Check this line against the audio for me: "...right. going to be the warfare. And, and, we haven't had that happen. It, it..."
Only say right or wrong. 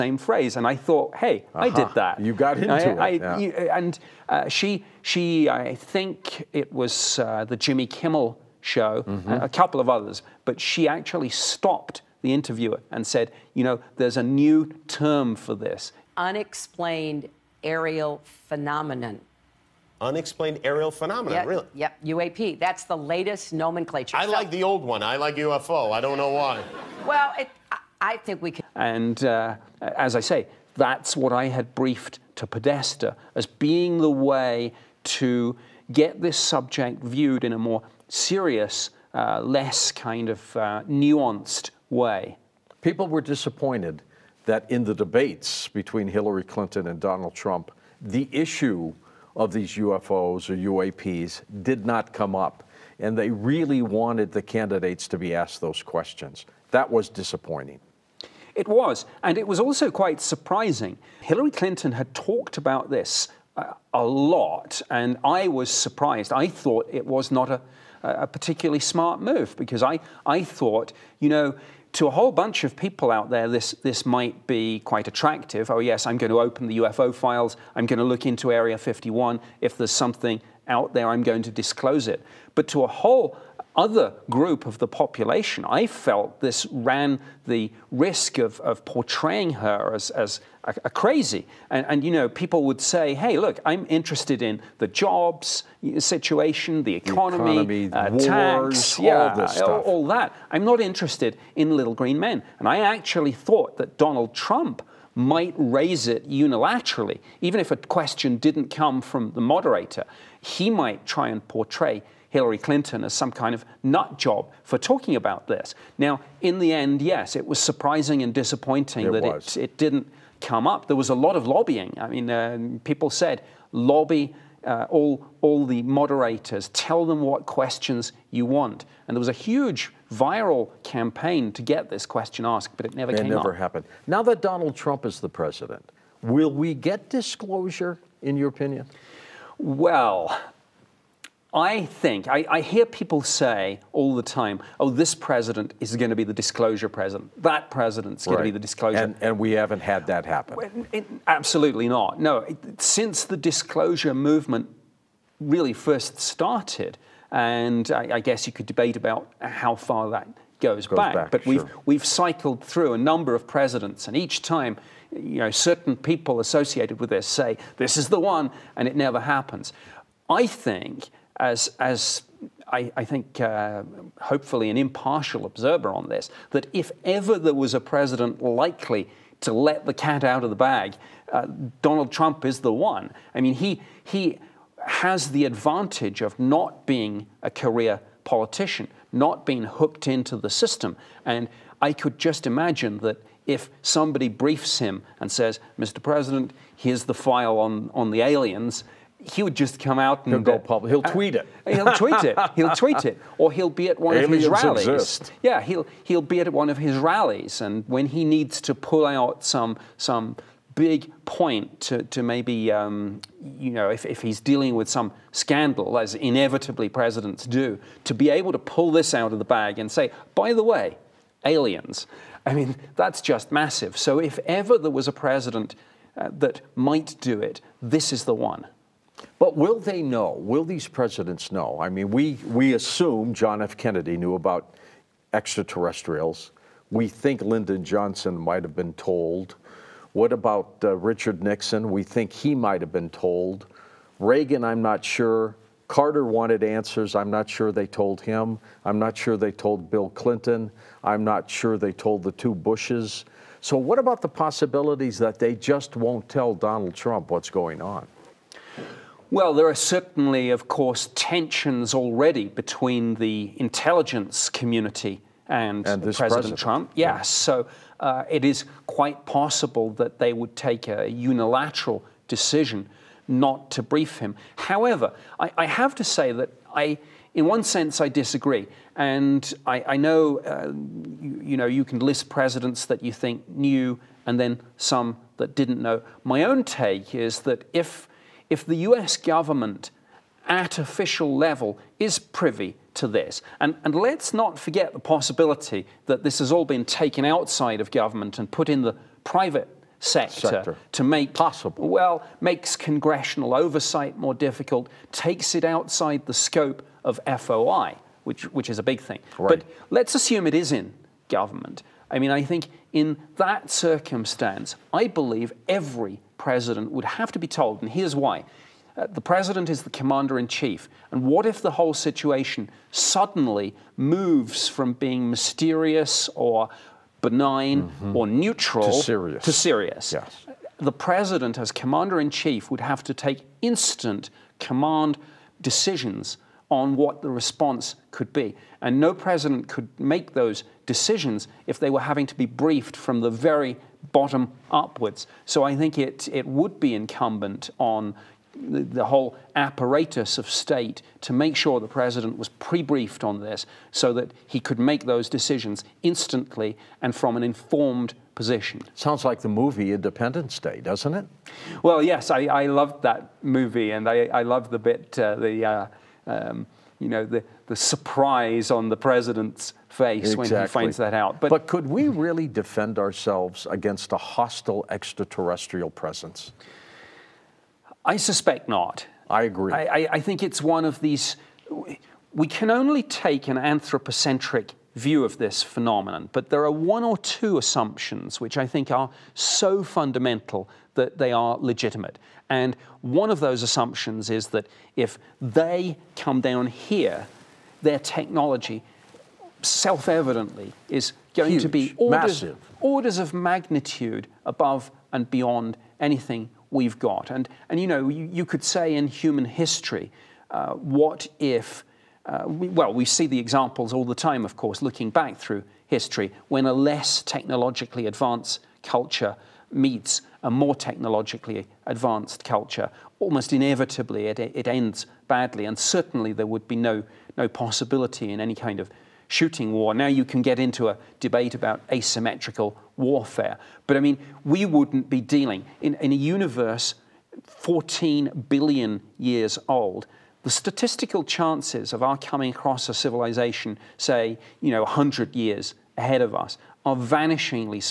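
wrong.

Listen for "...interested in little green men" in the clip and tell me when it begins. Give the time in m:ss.
1:40.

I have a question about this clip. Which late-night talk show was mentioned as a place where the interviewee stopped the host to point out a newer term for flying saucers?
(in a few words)
Jimmy Kimmel show.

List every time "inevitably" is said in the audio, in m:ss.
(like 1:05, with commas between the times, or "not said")
3:36, 7:03.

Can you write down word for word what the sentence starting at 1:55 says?
Now, in the end, yes, it was surprising and disappointing it that it, it, didn't come up.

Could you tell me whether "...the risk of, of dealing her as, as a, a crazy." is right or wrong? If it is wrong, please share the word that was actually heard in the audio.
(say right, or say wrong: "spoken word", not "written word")
wrong: "portraying", not "dealing".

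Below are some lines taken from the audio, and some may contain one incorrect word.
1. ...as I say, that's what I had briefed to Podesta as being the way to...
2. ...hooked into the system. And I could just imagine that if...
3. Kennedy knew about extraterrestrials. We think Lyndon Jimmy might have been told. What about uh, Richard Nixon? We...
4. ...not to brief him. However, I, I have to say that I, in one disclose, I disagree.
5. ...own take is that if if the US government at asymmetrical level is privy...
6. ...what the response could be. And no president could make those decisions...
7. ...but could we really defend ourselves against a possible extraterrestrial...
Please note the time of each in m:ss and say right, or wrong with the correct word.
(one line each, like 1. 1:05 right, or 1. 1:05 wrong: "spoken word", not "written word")
1. 0:29 right
2. 3:09 right
3. 3:53 wrong: "Johnson", not "Jimmy"
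4. 4:33 wrong: "sense", not "disclose"
5. 4:46 wrong: "official", not "asymmetrical"
6. 5:36 right
7. 6:11 wrong: "hostile", not "possible".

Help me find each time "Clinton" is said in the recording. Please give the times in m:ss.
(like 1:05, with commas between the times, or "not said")
0:46, 1:01, 1:52, 4:10.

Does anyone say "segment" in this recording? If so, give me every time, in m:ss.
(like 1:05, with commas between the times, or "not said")
not said.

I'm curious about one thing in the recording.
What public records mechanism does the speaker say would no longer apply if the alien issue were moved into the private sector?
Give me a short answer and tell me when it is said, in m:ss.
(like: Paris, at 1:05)
FOI, at 5:07.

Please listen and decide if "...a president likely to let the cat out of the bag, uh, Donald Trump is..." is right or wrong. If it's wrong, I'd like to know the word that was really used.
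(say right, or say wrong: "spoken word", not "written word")
right.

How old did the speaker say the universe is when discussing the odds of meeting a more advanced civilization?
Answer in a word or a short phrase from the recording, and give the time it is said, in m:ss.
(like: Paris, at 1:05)
14 billion years, at 7:17.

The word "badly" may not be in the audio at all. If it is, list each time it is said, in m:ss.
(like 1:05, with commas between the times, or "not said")
7:05.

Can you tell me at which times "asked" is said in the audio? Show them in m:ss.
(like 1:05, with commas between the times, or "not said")
0:55, 2:12.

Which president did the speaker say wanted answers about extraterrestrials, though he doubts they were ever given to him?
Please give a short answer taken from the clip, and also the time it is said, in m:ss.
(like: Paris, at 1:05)
Carter, at 4:05.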